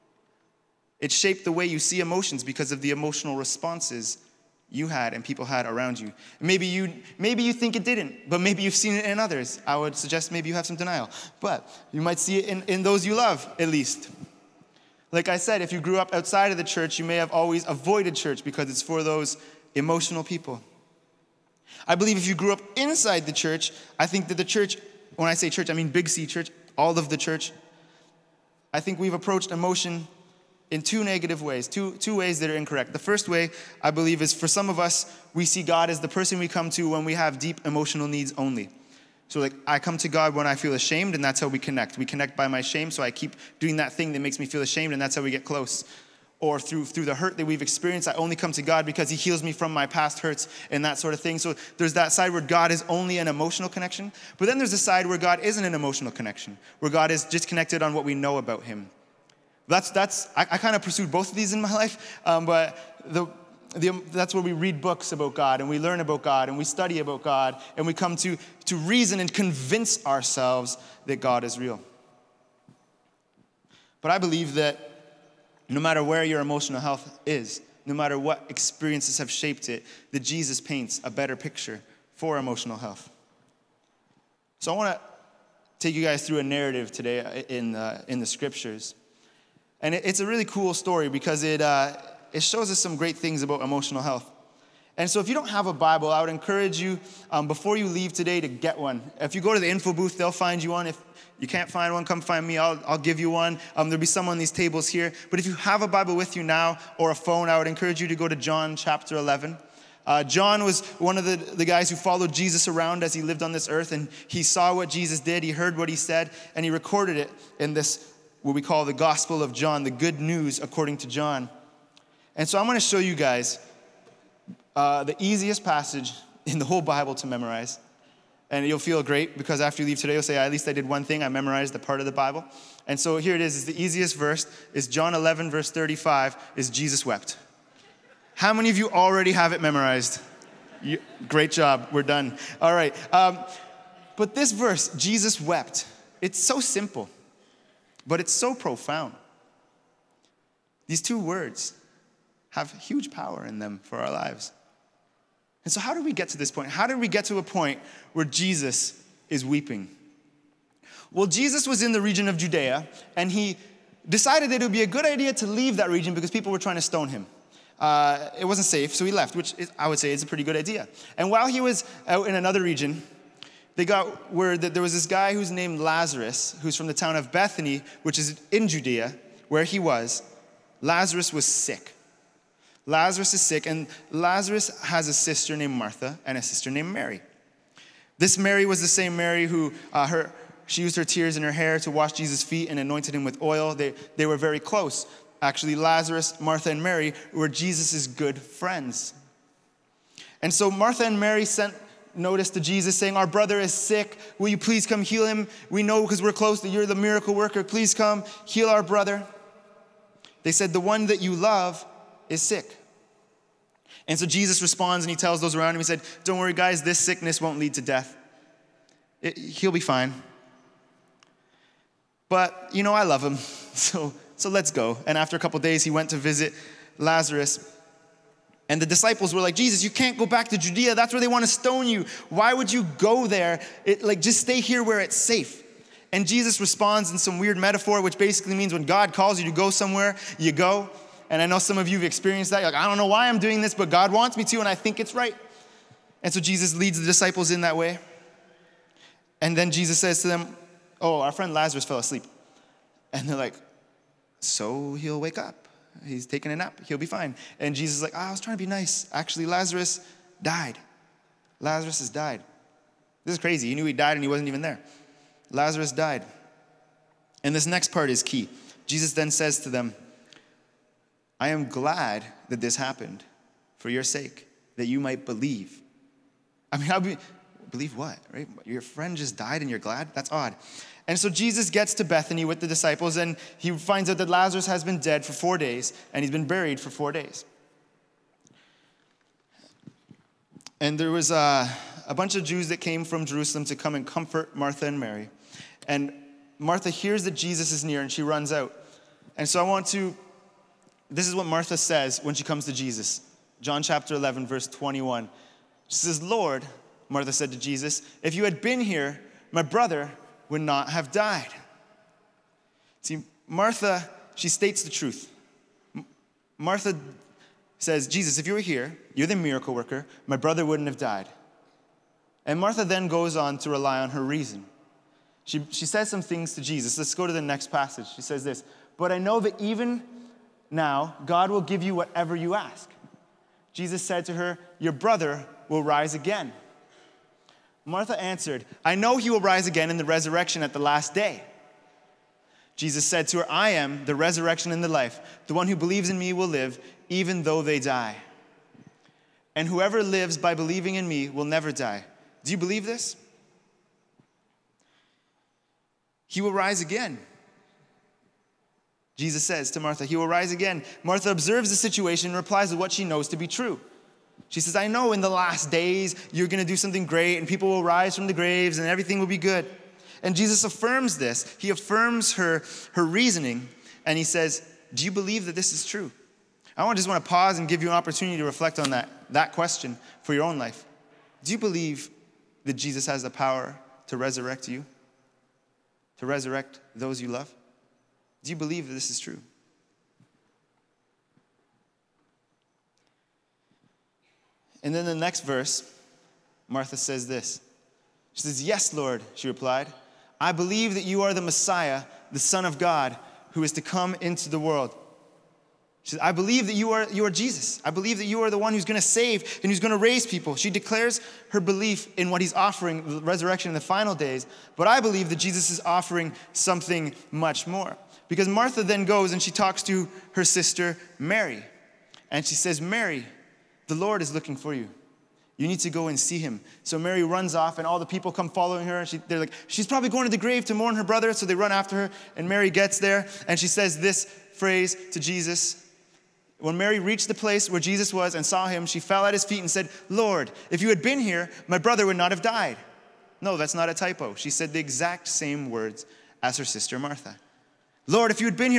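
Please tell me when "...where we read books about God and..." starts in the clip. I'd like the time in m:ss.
1:04.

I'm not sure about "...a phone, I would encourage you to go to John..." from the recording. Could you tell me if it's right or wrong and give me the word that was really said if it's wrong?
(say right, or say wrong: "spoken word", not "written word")
right.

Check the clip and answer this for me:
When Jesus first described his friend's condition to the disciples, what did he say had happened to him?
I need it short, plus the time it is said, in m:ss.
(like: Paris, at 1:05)
Fell asleep, at 4:11.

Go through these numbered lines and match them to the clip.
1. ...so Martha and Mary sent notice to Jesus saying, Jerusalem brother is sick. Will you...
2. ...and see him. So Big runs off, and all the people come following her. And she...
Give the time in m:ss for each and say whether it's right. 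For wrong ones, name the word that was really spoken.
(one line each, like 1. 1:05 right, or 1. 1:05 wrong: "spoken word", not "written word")
1. 3:20 wrong: "Our", not "Jerusalem"
2. 7:06 wrong: "Mary", not "Big".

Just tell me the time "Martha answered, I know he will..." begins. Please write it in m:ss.
5:37.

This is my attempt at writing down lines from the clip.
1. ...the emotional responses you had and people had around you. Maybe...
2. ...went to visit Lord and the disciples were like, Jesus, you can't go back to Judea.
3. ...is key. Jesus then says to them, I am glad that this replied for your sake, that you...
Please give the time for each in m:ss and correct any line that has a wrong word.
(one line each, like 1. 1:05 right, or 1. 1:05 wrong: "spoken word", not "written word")
1. 0:02 right
2. 3:45 wrong: "Lazarus", not "Lord"
3. 4:28 wrong: "happened", not "replied".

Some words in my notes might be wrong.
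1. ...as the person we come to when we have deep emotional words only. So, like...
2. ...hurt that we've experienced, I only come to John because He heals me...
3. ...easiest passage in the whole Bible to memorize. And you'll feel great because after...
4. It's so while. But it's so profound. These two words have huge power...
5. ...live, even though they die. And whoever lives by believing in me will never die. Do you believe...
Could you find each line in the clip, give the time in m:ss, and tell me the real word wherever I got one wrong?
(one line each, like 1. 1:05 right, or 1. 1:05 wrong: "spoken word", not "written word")
1. 0:35 wrong: "needs", not "words"
2. 0:47 wrong: "God", not "John"
3. 2:05 right
4. 2:26 wrong: "simple", not "while"
5. 5:46 right.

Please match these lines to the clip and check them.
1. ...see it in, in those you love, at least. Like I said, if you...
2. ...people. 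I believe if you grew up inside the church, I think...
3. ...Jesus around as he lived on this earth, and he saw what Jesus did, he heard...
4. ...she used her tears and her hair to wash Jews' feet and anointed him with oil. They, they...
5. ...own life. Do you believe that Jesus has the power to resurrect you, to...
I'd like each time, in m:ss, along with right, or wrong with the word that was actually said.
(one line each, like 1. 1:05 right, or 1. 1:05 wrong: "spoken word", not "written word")
1. 0:12 right
2. 0:20 right
3. 1:52 right
4. 3:10 wrong: "Jesus", not "Jews"
5. 6:20 right.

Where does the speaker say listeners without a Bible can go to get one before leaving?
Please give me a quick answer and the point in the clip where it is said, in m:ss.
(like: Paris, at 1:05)
The info booth, at 1:39.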